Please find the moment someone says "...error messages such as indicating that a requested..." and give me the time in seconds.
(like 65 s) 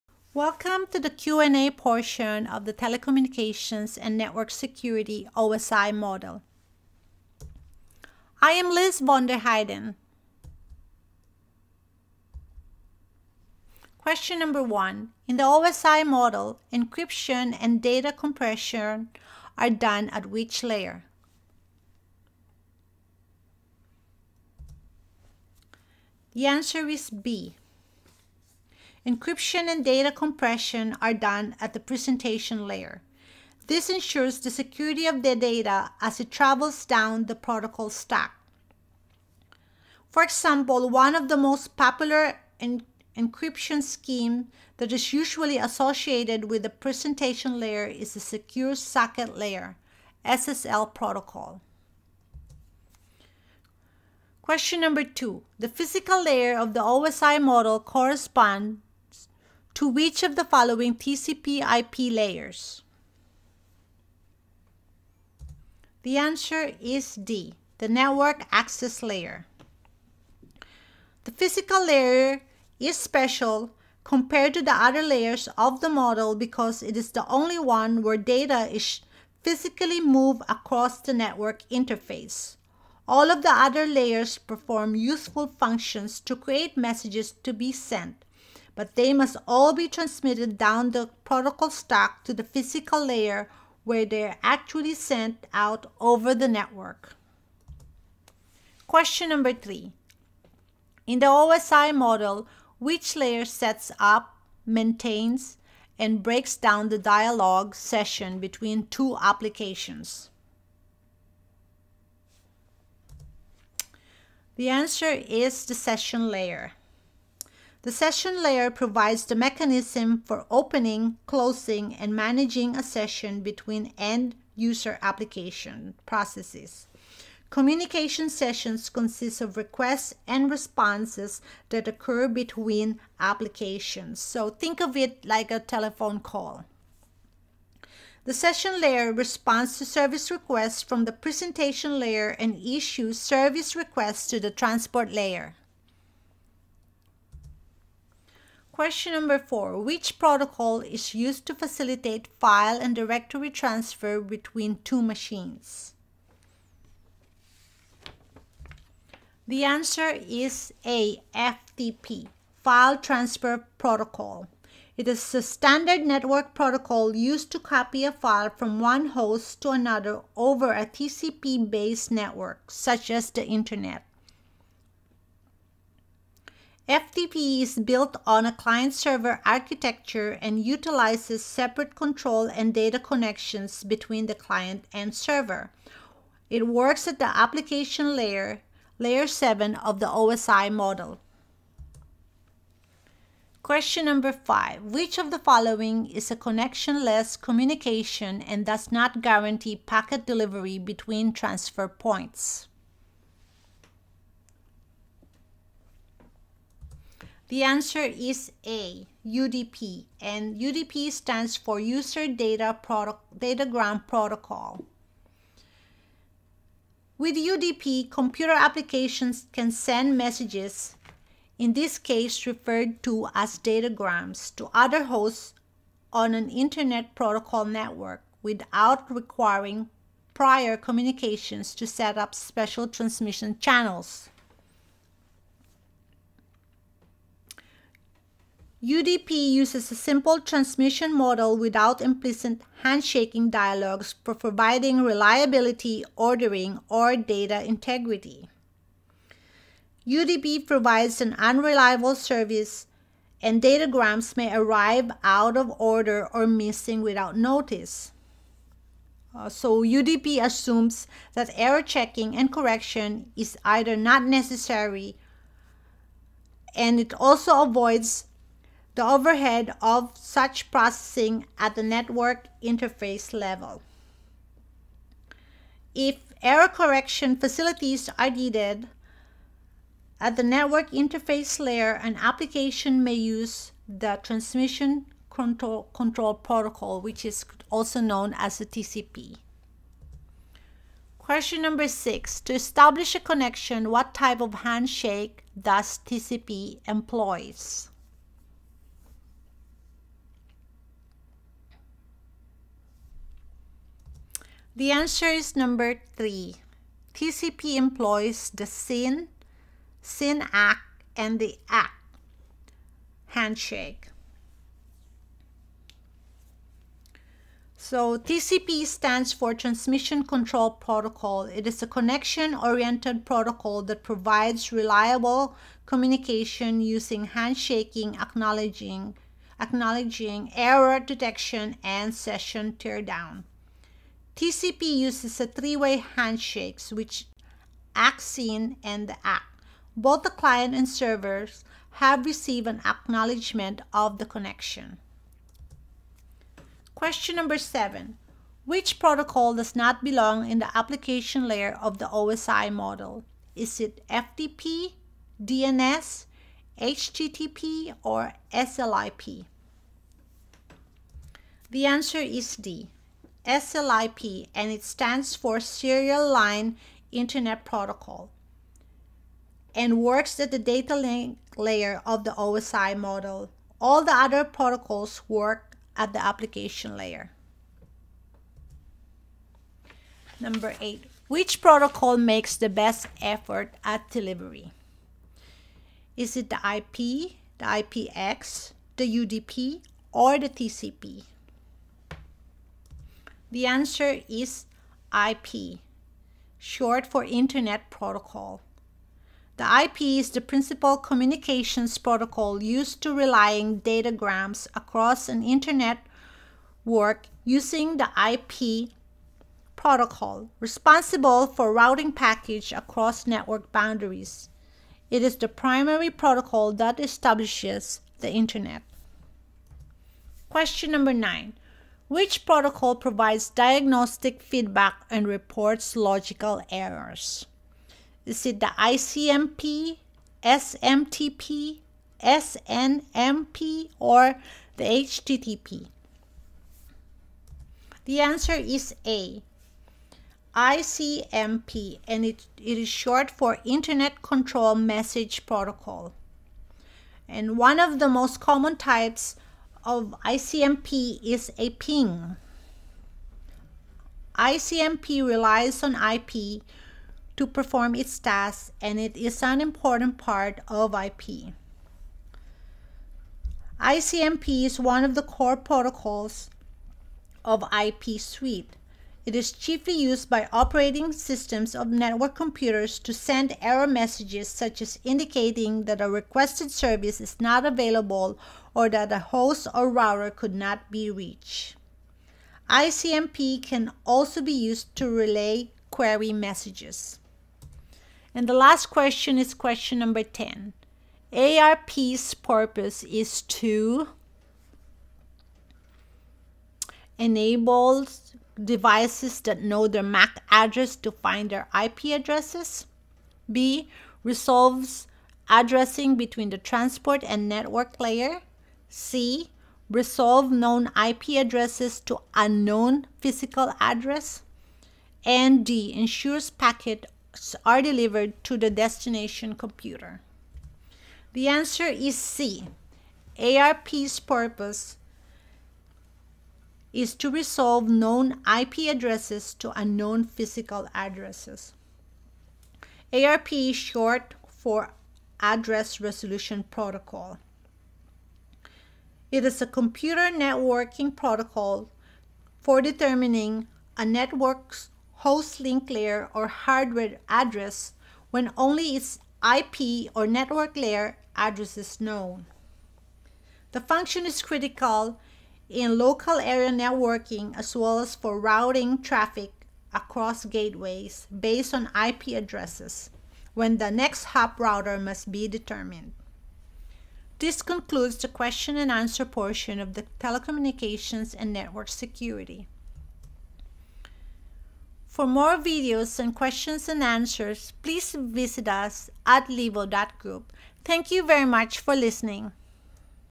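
473 s.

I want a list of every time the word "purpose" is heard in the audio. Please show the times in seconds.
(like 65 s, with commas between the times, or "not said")
492 s, 524 s.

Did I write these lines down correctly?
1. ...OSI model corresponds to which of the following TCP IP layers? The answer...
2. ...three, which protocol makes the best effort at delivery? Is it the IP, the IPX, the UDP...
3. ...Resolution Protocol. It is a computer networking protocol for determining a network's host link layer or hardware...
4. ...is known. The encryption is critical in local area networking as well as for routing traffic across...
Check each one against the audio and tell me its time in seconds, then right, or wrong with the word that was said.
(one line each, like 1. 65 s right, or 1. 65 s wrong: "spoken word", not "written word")
1. 56 s right
2. 380 s wrong: "eight", not "three"
3. 535 s right
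4. 551 s wrong: "function", not "encryption".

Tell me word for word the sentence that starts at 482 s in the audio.
ICMP can also be used to relay query messages.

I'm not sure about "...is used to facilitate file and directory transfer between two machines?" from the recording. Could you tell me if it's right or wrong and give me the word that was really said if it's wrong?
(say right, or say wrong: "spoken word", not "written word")
right.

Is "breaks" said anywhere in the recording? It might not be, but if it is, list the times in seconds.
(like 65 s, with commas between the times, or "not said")
106 s.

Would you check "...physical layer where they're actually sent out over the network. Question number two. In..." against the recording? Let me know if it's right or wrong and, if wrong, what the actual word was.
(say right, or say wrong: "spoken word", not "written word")
wrong: "three", not "two".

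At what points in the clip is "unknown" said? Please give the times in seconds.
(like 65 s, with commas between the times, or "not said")
512 s, 529 s.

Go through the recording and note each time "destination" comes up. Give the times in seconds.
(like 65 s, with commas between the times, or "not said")
518 s.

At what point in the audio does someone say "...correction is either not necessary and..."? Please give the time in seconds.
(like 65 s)
262 s.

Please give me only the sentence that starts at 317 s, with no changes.
So TCP stands for Transmission Control Protocol.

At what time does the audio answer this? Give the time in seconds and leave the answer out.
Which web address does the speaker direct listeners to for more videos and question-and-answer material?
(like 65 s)
579 s.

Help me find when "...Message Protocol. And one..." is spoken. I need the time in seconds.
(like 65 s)
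444 s.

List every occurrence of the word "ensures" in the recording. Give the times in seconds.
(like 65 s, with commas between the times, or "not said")
33 s, 515 s.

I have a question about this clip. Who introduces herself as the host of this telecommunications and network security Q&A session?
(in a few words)
Liz von der Heiden.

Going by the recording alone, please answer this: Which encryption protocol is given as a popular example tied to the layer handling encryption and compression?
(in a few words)
Secure Socket Layer.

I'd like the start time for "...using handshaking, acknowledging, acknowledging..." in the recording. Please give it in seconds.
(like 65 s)
326 s.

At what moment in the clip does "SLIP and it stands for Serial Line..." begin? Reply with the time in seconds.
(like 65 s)
363 s.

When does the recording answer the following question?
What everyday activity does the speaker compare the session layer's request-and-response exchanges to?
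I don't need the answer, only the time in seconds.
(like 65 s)
135 s.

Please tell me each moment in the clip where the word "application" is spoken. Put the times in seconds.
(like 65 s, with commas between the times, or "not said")
109 s, 125 s, 133 s, 187 s, 218 s, 282 s, 350 s, 376 s.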